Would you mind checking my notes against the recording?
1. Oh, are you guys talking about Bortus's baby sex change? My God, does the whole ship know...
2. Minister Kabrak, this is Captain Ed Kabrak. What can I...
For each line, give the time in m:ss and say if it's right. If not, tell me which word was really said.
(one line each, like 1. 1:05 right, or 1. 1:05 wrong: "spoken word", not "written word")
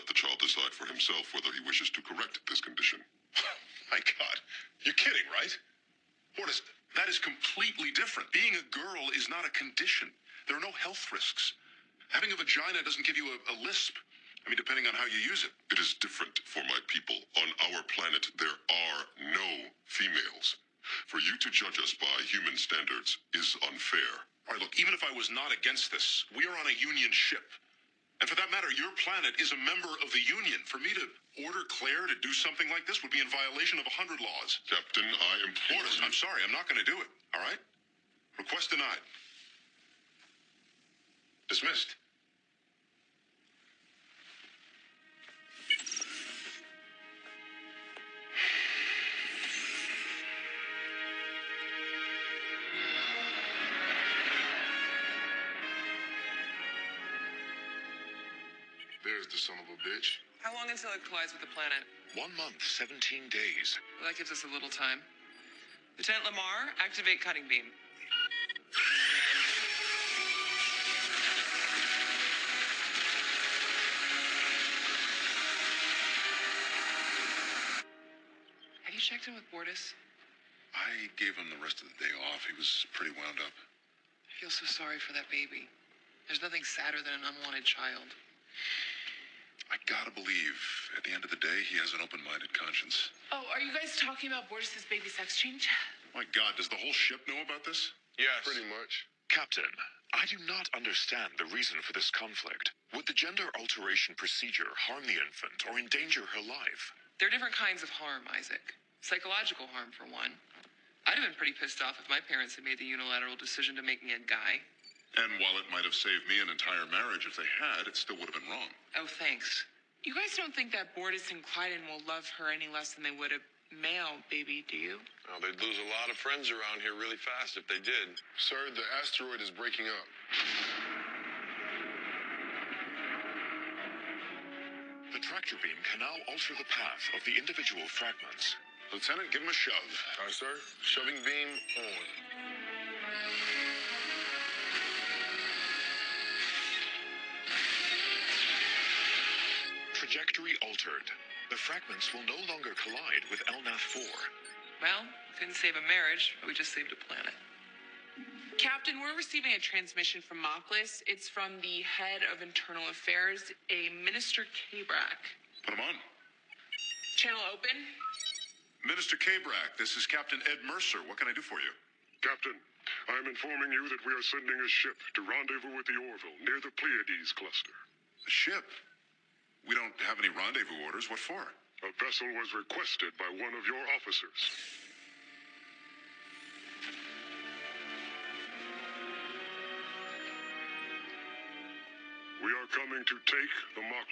1. 1:33 right
2. 2:48 wrong: "Mercer", not "Kabrak".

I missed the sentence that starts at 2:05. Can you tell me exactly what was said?
Oh, they'd lose a lot of friends around here really fast if they did.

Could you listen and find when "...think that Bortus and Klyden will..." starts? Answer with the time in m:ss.
2:00.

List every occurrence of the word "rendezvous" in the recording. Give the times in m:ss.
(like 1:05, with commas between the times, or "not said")
2:55, 3:00.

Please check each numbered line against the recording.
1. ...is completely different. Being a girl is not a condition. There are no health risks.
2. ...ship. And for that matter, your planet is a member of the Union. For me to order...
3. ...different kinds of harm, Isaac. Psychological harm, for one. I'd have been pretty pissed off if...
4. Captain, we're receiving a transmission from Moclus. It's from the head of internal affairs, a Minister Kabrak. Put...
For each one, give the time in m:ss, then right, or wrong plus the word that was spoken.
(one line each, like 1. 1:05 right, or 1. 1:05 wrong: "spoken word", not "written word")
1. 0:07 right
2. 0:27 right
3. 1:47 right
4. 2:38 right.